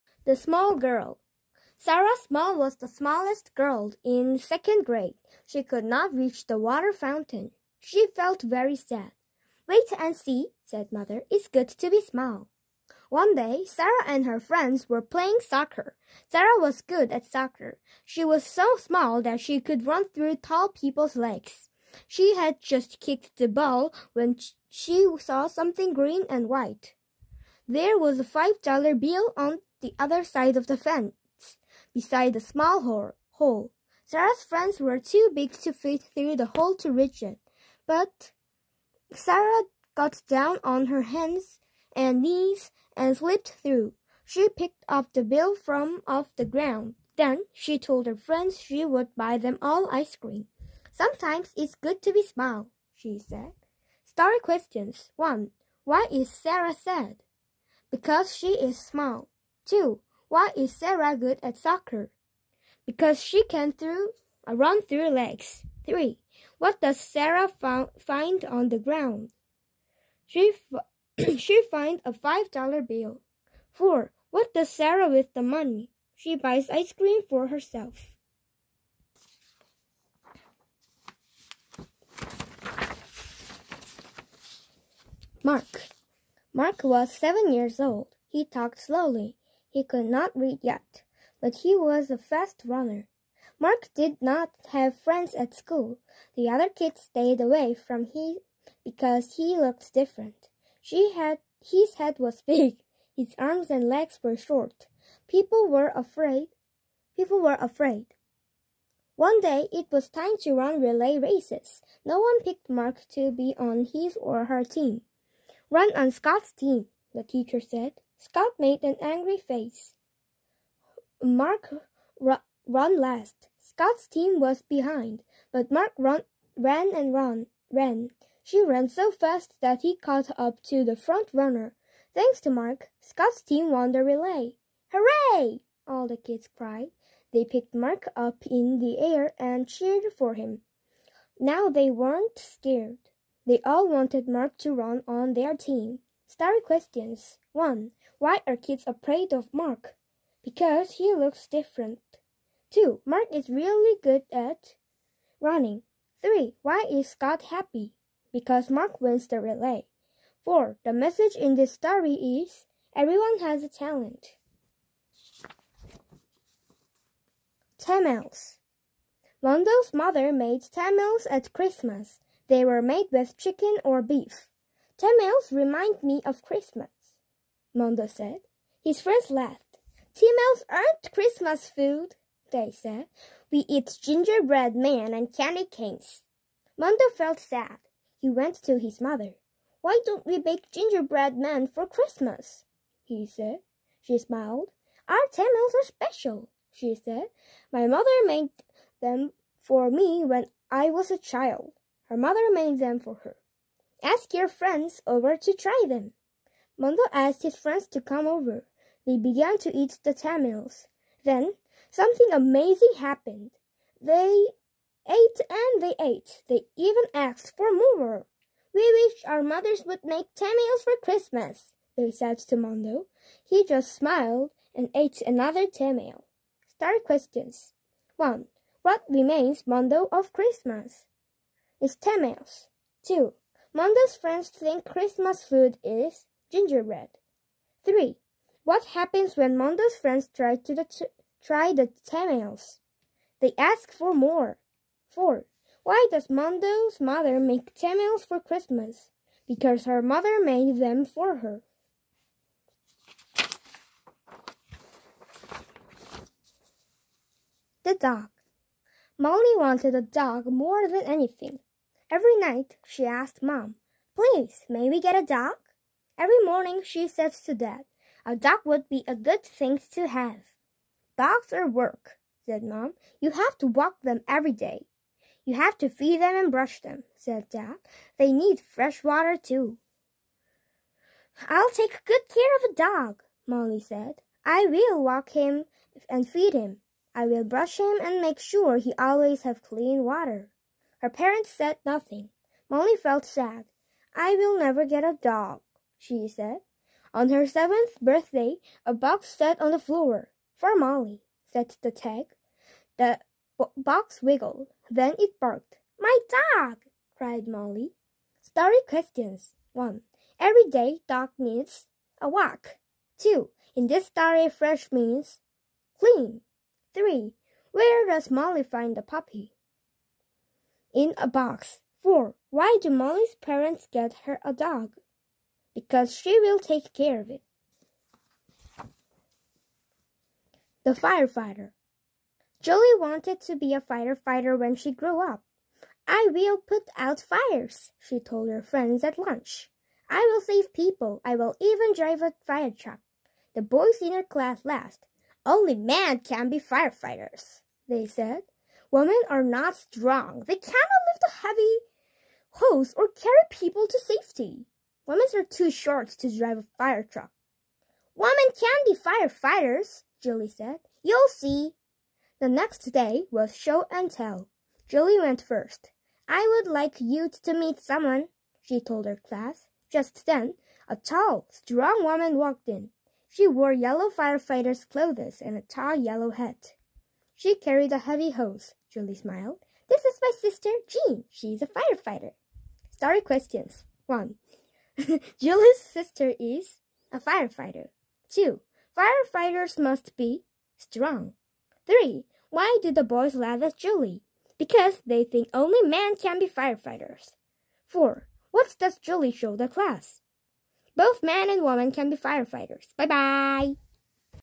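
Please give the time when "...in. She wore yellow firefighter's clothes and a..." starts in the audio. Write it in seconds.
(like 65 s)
372 s.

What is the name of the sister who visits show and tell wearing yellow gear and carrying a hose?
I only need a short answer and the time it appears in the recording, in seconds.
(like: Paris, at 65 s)
Jean, at 380 s.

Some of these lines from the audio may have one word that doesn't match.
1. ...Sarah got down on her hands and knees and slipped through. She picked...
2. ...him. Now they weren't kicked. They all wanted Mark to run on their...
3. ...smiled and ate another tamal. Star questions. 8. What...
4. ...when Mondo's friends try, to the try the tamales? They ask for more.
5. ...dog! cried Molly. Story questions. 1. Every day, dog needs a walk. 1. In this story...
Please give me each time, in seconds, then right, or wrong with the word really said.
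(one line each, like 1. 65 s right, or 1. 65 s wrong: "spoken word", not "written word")
1. 39 s right
2. 140 s wrong: "scared", not "kicked"
3. 223 s wrong: "1", not "8"
4. 239 s right
5. 306 s wrong: "2", not "1".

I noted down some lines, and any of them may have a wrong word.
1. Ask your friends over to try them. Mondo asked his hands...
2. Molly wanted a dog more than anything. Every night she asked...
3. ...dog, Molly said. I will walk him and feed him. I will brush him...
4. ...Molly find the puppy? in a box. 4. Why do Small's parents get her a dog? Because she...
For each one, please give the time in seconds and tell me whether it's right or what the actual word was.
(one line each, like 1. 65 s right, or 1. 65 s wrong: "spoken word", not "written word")
1. 204 s wrong: "friends", not "hands"
2. 259 s right
3. 282 s right
4. 318 s wrong: "Molly", not "Small".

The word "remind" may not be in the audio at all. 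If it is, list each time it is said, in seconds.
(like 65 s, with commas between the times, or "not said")
175 s.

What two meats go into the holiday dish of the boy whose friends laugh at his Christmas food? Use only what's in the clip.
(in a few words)
Chicken or beef.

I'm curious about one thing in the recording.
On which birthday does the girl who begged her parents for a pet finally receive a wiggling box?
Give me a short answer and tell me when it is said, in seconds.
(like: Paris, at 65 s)
Seventh, at 297 s.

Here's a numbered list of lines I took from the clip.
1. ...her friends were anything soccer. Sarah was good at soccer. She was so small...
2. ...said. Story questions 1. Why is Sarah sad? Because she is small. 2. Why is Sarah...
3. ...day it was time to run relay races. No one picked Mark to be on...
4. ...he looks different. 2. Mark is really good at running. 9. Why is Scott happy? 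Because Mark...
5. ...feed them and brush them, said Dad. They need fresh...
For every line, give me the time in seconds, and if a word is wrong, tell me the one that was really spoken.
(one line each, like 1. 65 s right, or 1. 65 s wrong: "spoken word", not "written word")
1. 14 s wrong: "playing", not "anything"
2. 53 s right
3. 109 s right
4. 150 s wrong: "3", not "9"
5. 275 s right.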